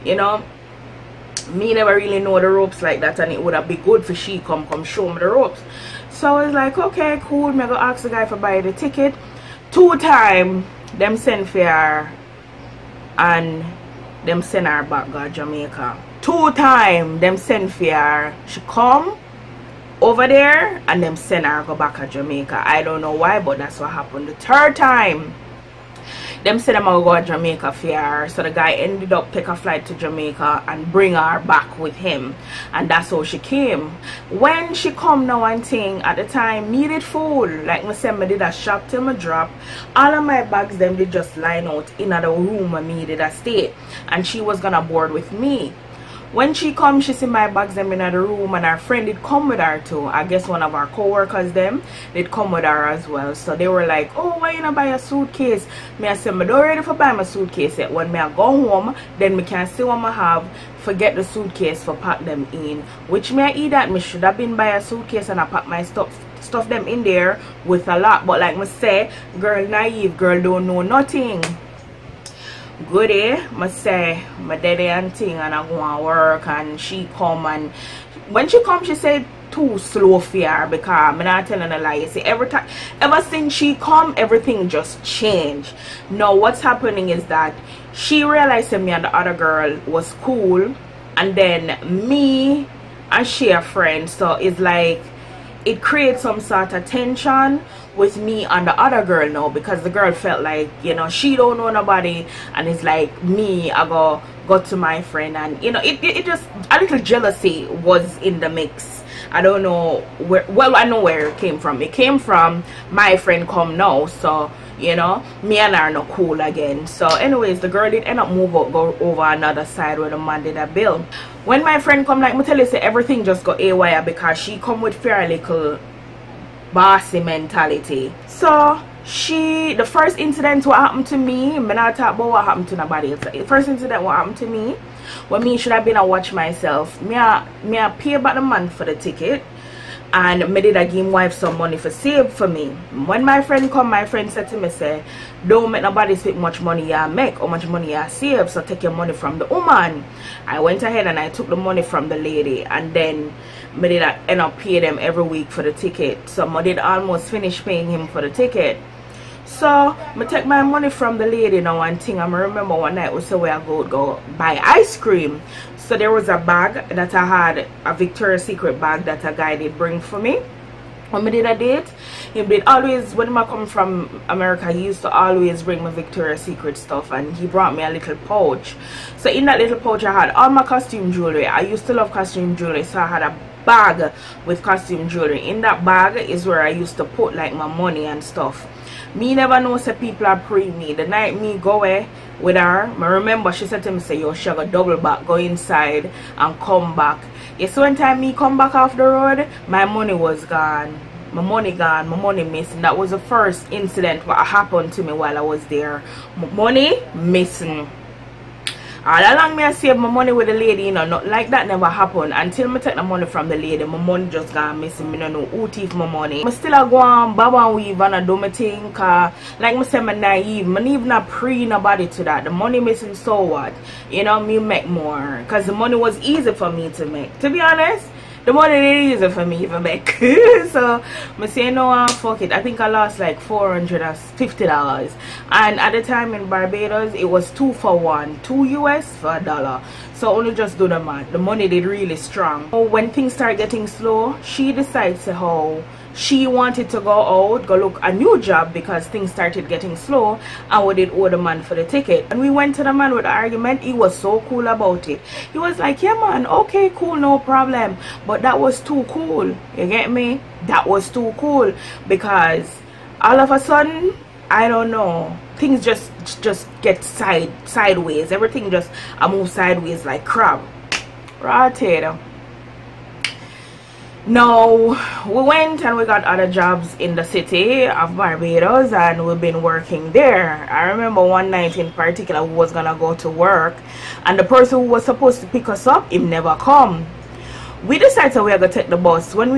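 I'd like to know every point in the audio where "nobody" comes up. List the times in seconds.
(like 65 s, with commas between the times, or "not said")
101 s, 132 s, 145 s, 221 s.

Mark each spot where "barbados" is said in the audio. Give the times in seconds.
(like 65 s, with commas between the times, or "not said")
236 s, 278 s.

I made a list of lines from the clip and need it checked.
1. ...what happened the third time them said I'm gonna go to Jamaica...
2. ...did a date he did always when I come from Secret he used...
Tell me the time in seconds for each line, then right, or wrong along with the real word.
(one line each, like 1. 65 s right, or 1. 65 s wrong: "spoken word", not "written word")
1. 23 s right
2. 171 s wrong: "America", not "Secret".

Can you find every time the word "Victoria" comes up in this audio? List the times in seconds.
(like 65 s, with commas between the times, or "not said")
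167 s, 175 s.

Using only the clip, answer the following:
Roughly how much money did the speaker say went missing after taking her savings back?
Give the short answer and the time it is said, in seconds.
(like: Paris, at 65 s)
450 dollars, at 233 s.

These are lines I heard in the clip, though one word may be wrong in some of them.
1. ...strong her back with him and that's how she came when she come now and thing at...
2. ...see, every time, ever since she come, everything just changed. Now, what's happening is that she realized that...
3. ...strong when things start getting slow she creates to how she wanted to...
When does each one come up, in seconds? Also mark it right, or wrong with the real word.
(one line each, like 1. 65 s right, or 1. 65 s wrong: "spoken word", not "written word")
1. 30 s wrong: "bring", not "strong"
2. 82 s right
3. 242 s wrong: "decides", not "creates".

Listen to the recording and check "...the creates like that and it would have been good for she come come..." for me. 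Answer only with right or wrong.
wrong.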